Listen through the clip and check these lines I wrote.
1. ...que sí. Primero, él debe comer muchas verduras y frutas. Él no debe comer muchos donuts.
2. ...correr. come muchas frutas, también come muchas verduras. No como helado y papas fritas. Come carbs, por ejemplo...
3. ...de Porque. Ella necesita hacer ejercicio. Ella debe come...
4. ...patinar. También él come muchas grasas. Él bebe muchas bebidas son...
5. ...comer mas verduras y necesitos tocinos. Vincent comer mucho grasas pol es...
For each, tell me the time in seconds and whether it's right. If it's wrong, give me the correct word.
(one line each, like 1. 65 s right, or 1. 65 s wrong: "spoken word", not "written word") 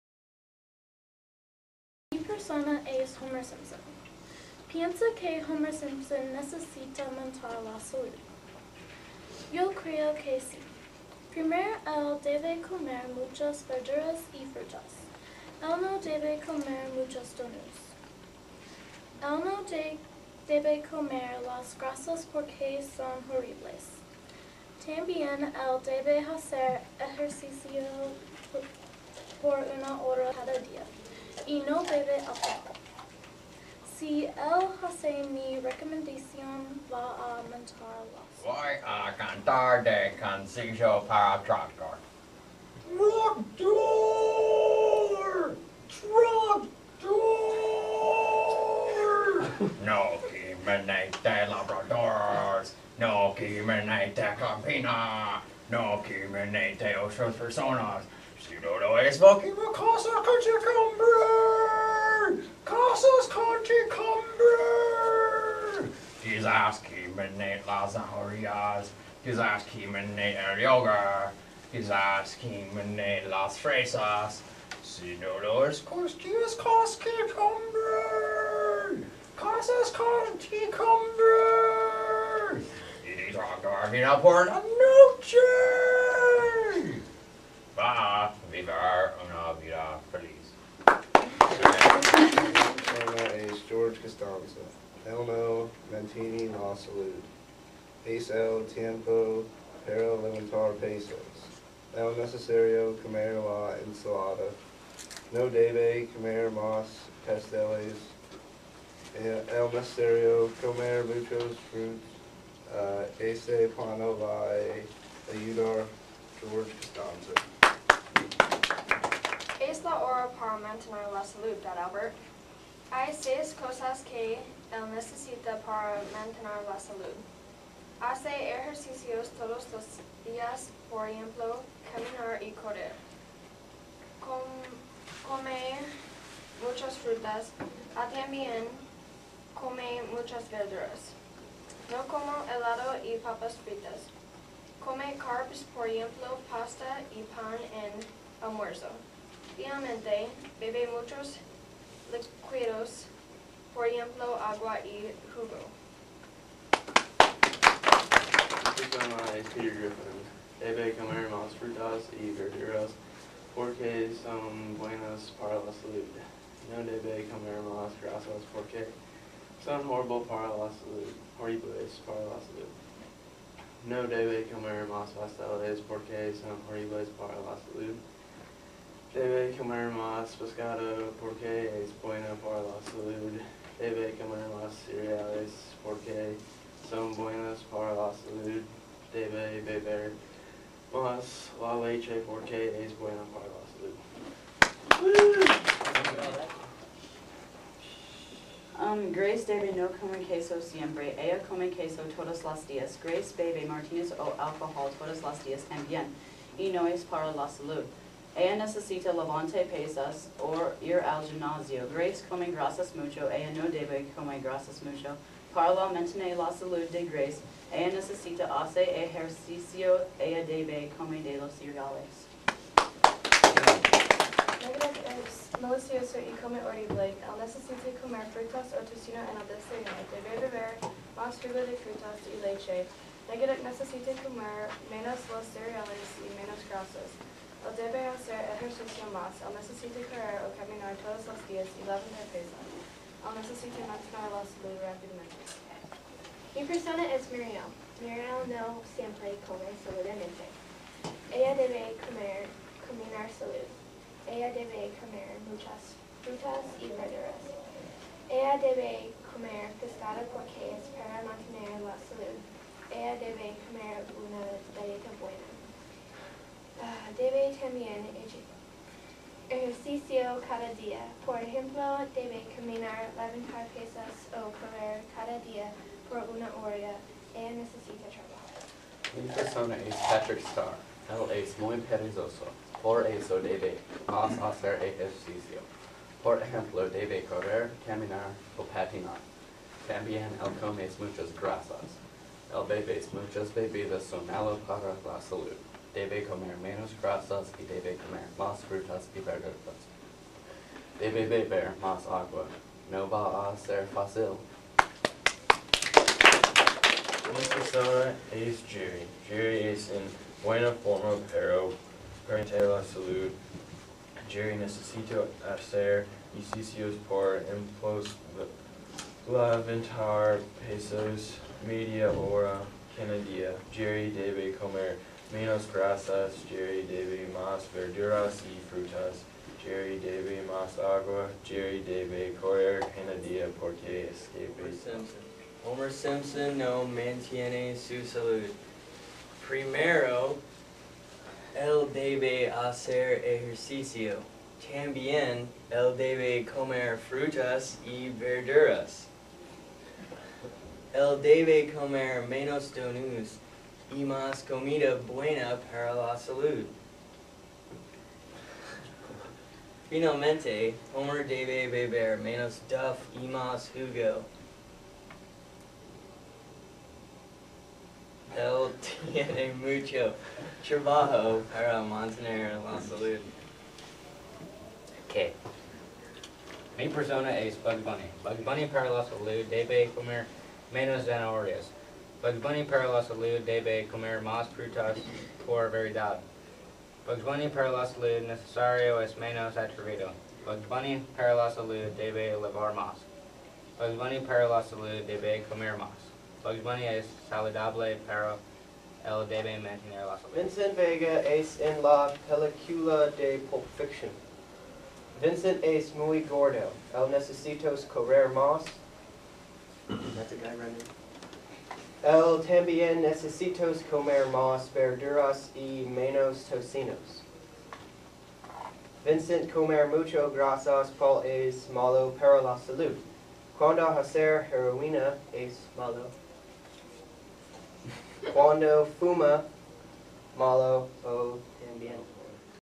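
1. 10 s right
2. 132 s right
3. 216 s wrong: "Grace", not "Porque"
4. 288 s right
5. 413 s wrong: "menos", not "necesitos".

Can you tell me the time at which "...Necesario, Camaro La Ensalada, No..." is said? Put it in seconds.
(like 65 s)
102 s.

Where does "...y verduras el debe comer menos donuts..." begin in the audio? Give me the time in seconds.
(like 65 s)
347 s.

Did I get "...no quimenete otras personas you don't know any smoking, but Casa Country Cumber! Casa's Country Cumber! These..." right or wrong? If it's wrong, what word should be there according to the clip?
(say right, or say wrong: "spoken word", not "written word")
right.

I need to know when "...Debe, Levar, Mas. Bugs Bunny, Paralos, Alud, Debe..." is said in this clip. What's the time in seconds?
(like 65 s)
391 s.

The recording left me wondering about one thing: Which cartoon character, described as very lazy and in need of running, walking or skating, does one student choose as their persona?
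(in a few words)
Patrick Star.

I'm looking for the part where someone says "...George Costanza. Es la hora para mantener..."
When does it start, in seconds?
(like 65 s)
116 s.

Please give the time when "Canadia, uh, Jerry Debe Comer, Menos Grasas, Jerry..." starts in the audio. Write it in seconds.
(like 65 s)
322 s.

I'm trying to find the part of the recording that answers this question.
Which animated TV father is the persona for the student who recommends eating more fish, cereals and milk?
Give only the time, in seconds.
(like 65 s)
159 s.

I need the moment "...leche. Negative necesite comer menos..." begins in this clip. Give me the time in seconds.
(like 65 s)
232 s.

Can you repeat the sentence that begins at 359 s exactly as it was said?
Finalmente, Homer debe beber menos Duff y más Hugo.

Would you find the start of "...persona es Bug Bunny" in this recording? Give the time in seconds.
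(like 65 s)
376 s.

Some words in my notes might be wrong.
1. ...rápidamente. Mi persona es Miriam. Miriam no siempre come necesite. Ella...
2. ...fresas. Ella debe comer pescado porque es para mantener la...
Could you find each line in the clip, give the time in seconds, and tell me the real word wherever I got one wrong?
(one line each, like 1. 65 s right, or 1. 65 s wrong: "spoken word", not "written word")
1. 244 s wrong: "saludablemente", not "necesite"
2. 256 s wrong: "verduras", not "fresas".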